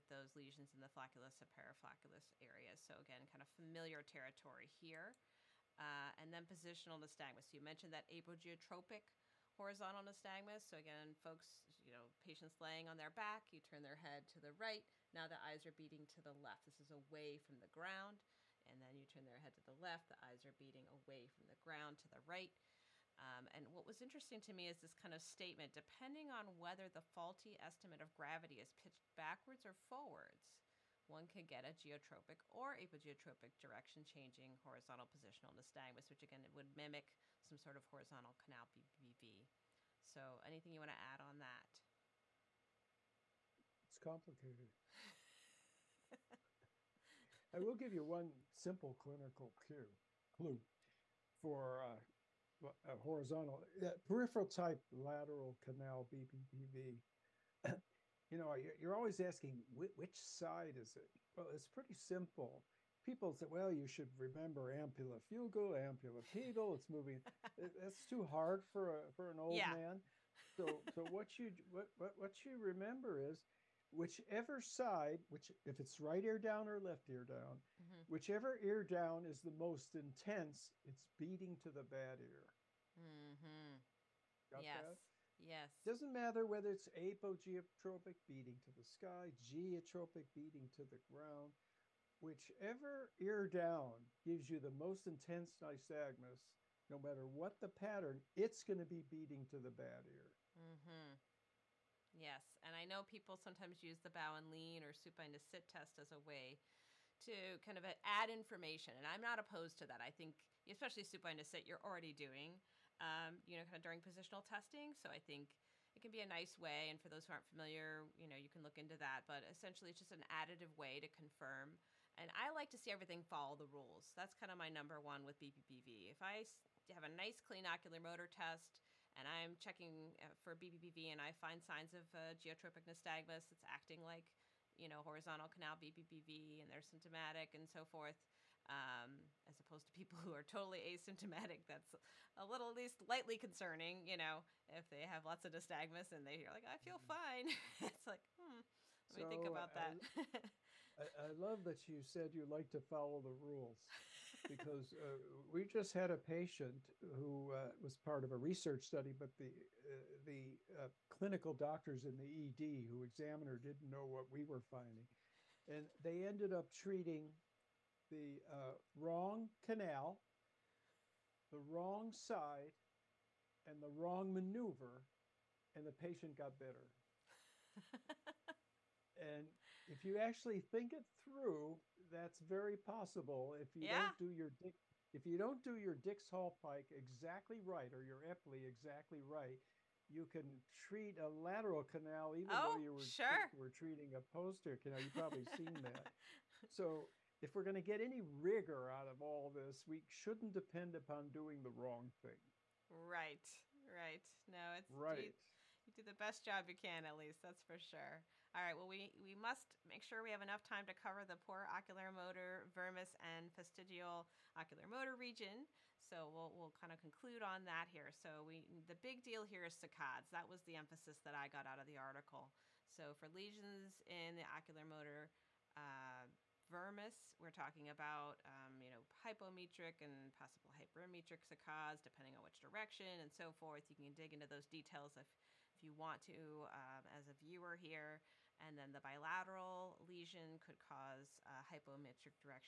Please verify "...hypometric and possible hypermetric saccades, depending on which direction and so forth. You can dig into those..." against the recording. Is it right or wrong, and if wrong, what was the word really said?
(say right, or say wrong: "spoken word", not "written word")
right.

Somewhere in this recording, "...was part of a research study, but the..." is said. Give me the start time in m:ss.
2:37.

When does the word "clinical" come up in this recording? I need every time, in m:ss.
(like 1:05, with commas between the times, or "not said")
0:48, 2:41.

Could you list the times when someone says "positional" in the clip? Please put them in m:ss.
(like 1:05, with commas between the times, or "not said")
0:06, 0:35, 1:54.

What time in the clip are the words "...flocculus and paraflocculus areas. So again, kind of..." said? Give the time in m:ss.
0:00.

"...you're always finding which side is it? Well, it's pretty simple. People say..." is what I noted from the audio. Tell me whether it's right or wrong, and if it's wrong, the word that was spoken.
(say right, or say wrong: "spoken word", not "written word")
wrong: "asking", not "finding".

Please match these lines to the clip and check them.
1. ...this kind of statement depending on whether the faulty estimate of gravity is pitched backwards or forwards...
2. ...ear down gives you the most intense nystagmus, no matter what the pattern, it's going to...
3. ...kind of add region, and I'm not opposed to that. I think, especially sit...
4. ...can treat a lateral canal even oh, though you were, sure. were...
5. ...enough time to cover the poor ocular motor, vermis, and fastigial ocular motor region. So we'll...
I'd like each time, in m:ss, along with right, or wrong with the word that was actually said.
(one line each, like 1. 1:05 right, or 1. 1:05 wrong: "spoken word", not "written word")
1. 0:24 right
2. 1:33 right
3. 1:47 wrong: "information", not "region"
4. 3:10 right
5. 3:30 right.